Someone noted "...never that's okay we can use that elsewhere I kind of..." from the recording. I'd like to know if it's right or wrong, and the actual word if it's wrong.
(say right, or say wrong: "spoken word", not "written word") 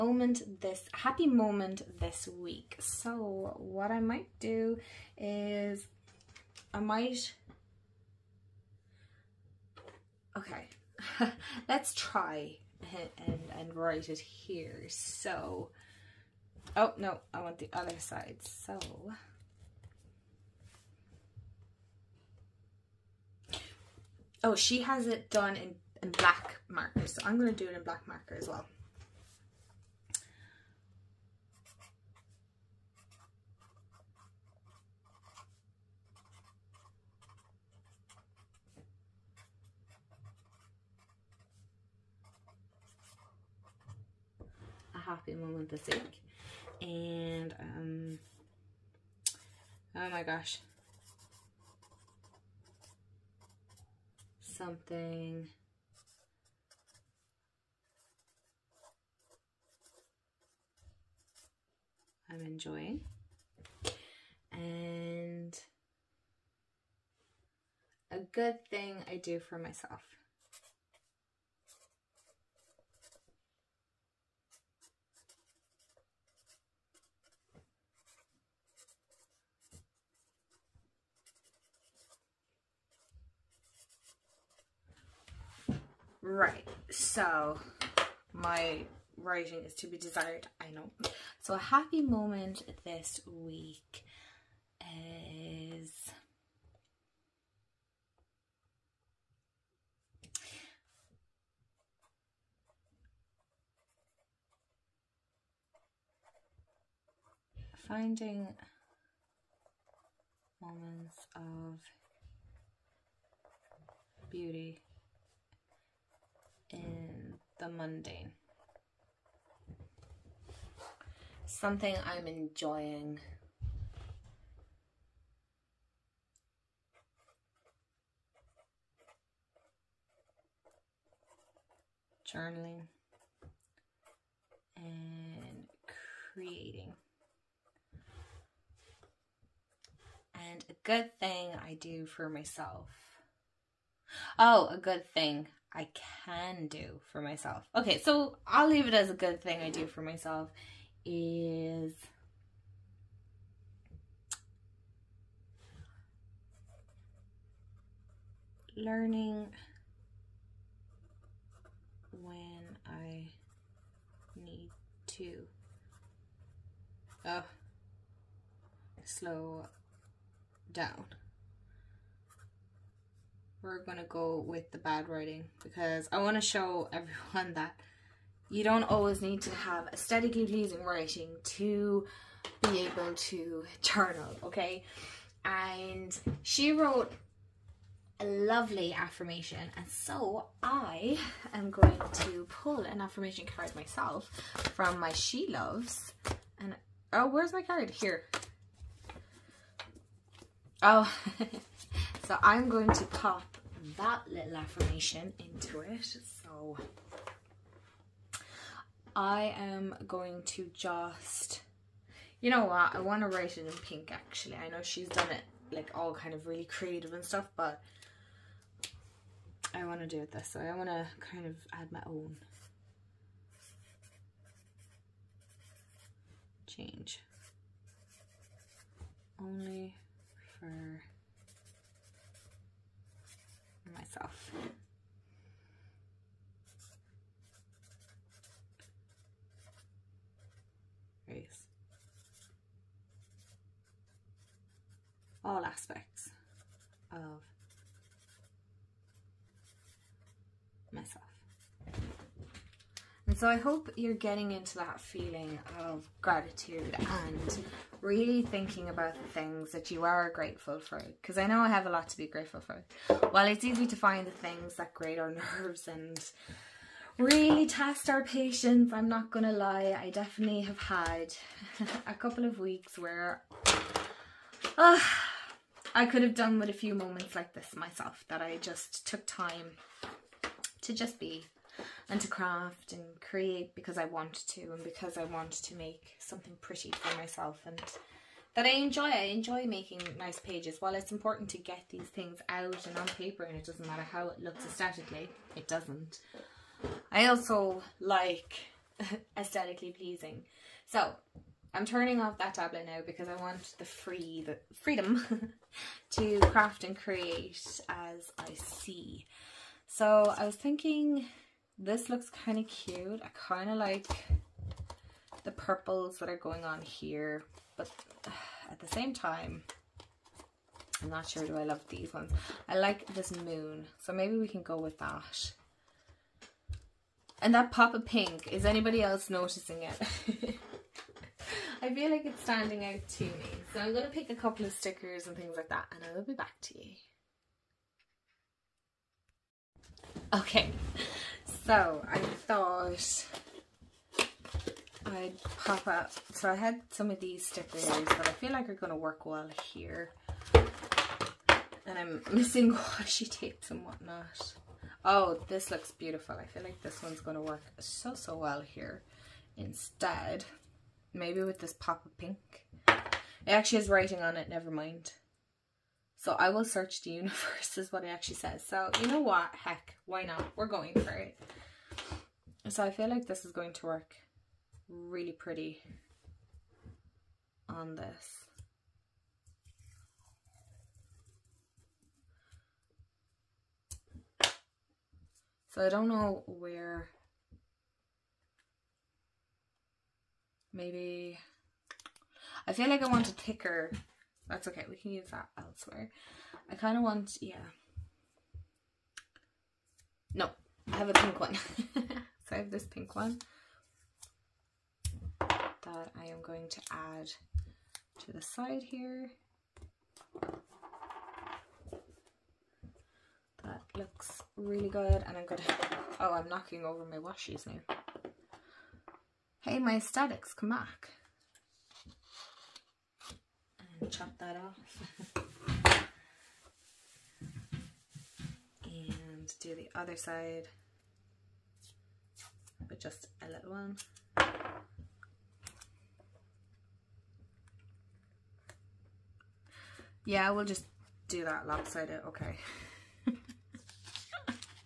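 wrong: "thicker", not "never".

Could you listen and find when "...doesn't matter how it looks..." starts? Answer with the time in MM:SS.
04:53.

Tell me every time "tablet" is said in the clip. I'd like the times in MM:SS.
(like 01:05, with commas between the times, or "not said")
05:02.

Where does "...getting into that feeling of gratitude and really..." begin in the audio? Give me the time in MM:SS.
04:14.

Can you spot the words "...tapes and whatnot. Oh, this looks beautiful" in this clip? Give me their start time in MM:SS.
05:53.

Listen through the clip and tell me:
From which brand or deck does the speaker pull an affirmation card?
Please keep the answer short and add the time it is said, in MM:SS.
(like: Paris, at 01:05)
She Loves, at 03:15.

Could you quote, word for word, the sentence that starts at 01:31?
So a happy moment this week is...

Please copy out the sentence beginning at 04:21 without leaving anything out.
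Because I know I have a lot to be grateful for.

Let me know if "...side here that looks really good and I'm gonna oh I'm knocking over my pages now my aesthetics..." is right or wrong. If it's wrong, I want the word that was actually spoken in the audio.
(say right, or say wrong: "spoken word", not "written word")
wrong: "washies", not "pages".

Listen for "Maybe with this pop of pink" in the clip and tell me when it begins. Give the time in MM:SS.
06:01.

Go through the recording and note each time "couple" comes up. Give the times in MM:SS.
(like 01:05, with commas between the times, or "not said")
04:32, 05:34.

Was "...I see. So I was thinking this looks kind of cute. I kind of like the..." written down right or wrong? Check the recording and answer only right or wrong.
right.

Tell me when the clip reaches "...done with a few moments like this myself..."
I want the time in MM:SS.
04:36.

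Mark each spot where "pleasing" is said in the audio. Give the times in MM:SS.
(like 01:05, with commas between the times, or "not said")
03:00, 04:59.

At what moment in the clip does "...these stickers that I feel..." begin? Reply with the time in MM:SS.
05:47.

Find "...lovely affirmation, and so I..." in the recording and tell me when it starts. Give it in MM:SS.
03:08.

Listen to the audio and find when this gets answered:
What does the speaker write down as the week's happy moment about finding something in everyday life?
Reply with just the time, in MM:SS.
01:47.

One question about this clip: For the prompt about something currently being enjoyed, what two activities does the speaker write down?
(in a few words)
Journaling and creating.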